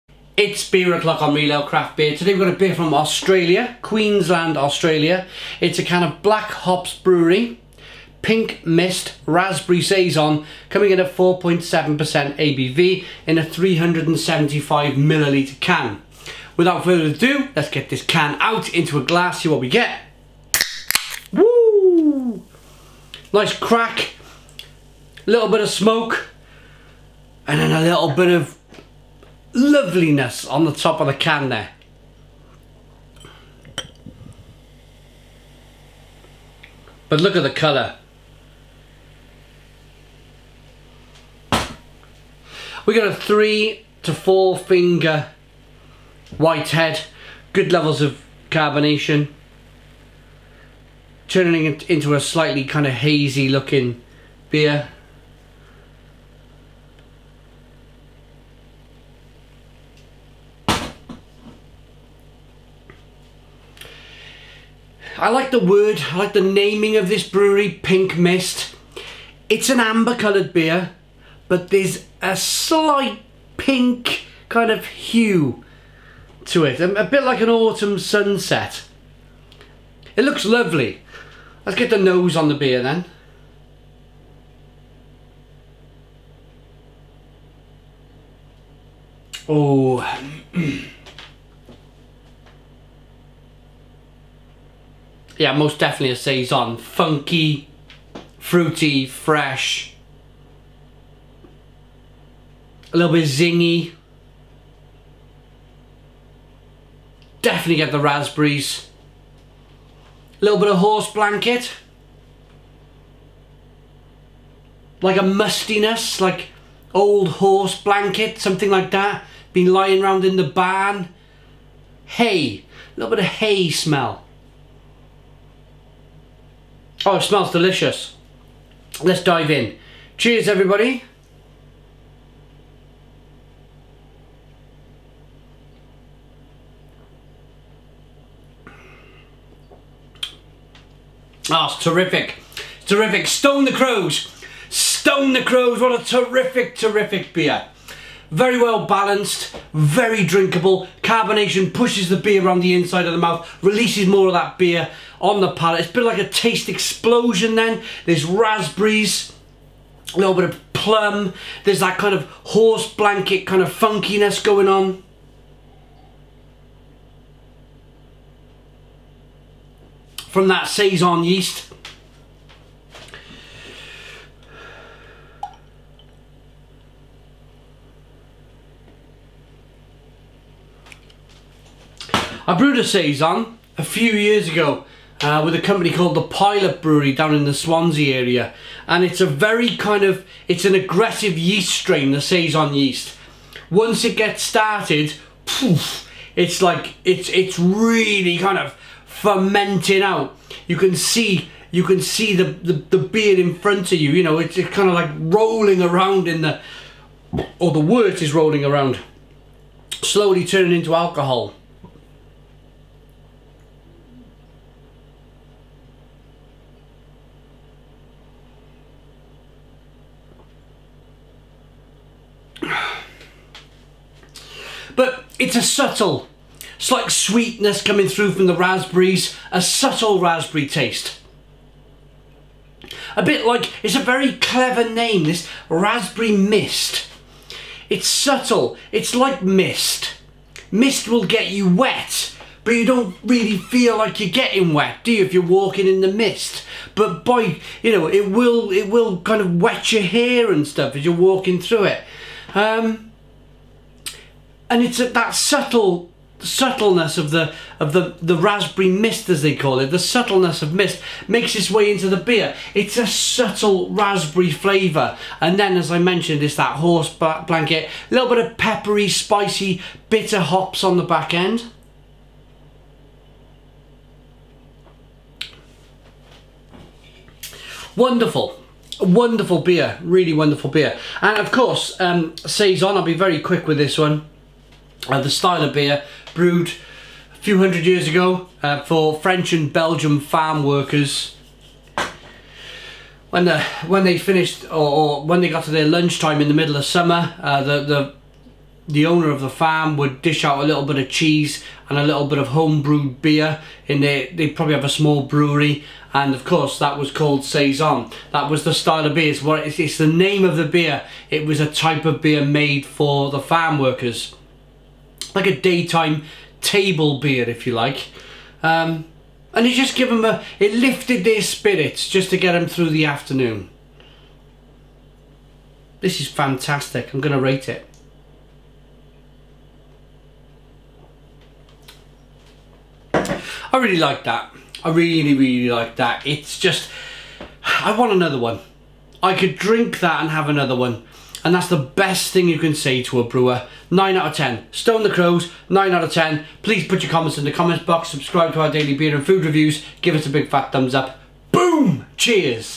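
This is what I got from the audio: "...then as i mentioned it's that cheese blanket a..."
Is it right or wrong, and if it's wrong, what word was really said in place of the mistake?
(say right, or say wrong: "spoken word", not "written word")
wrong: "horse", not "cheese".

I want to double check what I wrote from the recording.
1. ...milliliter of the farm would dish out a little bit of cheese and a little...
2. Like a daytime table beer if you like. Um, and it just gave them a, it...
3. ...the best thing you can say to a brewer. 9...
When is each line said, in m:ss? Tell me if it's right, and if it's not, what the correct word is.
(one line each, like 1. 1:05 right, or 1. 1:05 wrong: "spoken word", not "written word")
1. 4:59 wrong: "owner", not "milliliter"
2. 5:15 right
3. 5:41 right.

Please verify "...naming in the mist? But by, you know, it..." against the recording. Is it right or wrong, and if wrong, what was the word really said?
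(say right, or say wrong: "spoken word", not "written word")
wrong: "walking", not "naming".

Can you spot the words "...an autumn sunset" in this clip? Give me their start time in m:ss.
1:17.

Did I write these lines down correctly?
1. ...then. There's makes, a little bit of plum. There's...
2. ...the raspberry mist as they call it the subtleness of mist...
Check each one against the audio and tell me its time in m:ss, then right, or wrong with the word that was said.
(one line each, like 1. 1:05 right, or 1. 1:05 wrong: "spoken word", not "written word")
1. 2:37 wrong: "raspberries", not "makes"
2. 4:18 right.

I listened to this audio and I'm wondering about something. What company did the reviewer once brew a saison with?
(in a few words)
the Pilot Brewery.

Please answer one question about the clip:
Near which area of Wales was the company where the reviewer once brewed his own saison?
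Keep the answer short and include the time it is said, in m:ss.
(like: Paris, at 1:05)
Swansea, at 3:07.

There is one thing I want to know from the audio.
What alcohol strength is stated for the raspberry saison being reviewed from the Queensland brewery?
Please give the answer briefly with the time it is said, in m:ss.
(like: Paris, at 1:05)
4.7%, at 0:11.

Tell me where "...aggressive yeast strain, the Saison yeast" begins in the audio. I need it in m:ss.
3:10.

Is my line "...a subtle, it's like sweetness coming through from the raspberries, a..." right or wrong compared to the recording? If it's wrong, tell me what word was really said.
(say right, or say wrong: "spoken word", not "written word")
right.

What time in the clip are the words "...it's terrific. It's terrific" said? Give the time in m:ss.
2:21.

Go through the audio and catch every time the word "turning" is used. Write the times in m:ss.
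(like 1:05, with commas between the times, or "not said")
0:51, 3:30.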